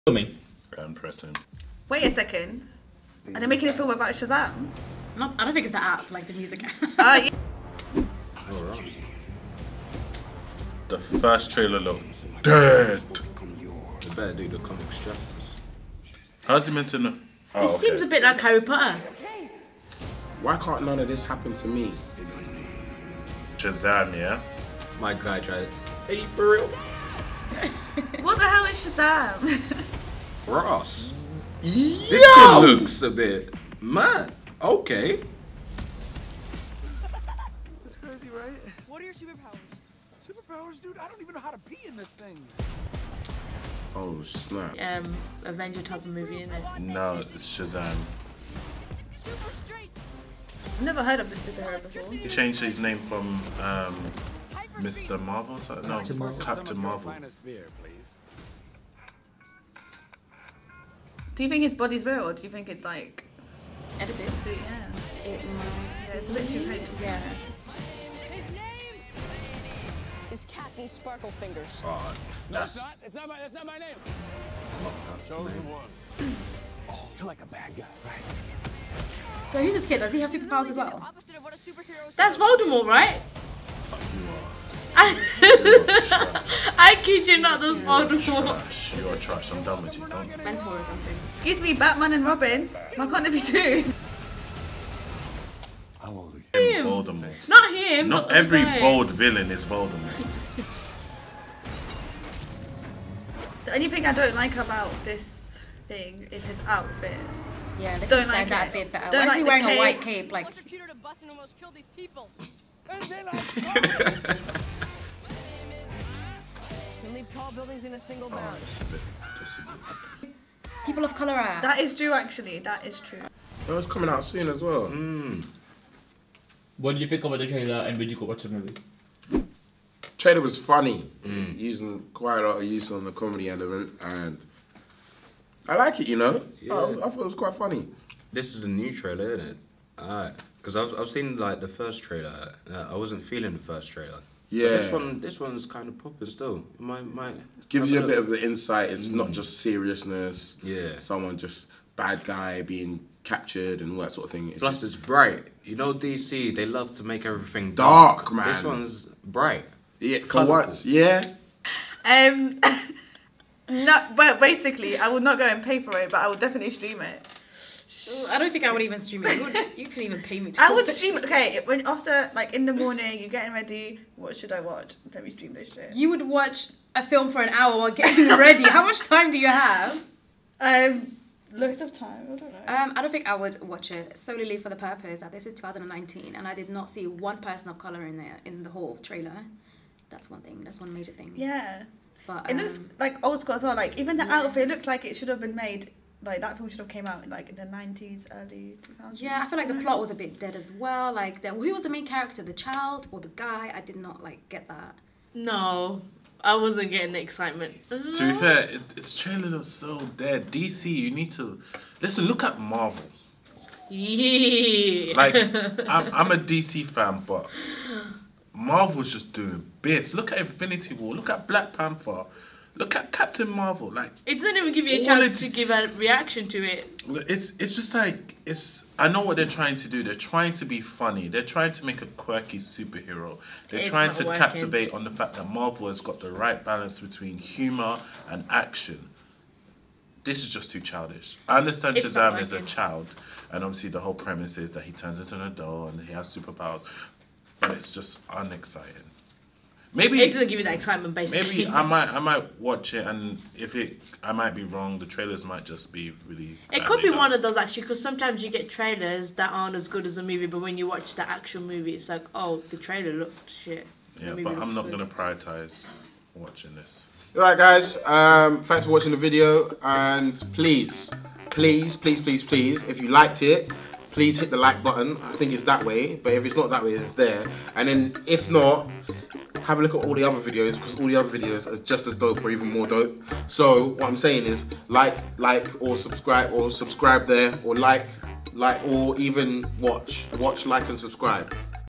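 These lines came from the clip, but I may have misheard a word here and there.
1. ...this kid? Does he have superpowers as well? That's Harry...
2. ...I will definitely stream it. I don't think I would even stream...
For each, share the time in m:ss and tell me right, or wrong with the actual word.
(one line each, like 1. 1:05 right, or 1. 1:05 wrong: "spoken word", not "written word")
1. 1:19 wrong: "Voldemort", not "Harry"
2. 2:46 right.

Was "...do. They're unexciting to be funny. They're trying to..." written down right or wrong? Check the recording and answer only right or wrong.
wrong.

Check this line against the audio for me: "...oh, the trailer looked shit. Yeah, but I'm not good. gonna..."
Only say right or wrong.
right.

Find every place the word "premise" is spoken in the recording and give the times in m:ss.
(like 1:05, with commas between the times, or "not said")
4:04.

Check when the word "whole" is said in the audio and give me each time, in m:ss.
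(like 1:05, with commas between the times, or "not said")
3:08, 4:03.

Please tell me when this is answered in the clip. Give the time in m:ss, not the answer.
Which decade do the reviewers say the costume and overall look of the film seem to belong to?
3:17.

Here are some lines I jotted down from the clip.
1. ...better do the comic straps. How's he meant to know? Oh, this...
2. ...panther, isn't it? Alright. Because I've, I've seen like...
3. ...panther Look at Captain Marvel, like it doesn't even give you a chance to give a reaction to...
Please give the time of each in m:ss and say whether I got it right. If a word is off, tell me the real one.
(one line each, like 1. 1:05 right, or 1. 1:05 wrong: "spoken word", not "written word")
1. 0:14 right
2. 2:18 wrong: "trailer", not "panther"
3. 3:41 right.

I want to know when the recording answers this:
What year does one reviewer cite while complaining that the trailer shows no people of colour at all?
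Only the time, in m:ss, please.
3:05.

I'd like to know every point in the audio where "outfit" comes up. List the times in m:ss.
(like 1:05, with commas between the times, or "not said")
1:46, 3:14.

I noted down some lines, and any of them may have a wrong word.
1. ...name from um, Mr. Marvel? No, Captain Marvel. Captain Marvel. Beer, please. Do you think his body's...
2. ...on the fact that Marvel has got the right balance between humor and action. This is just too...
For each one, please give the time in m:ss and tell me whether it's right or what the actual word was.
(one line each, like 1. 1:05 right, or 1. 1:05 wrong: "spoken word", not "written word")
1. 0:52 right
2. 3:54 right.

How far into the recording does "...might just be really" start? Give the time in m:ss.
4:15.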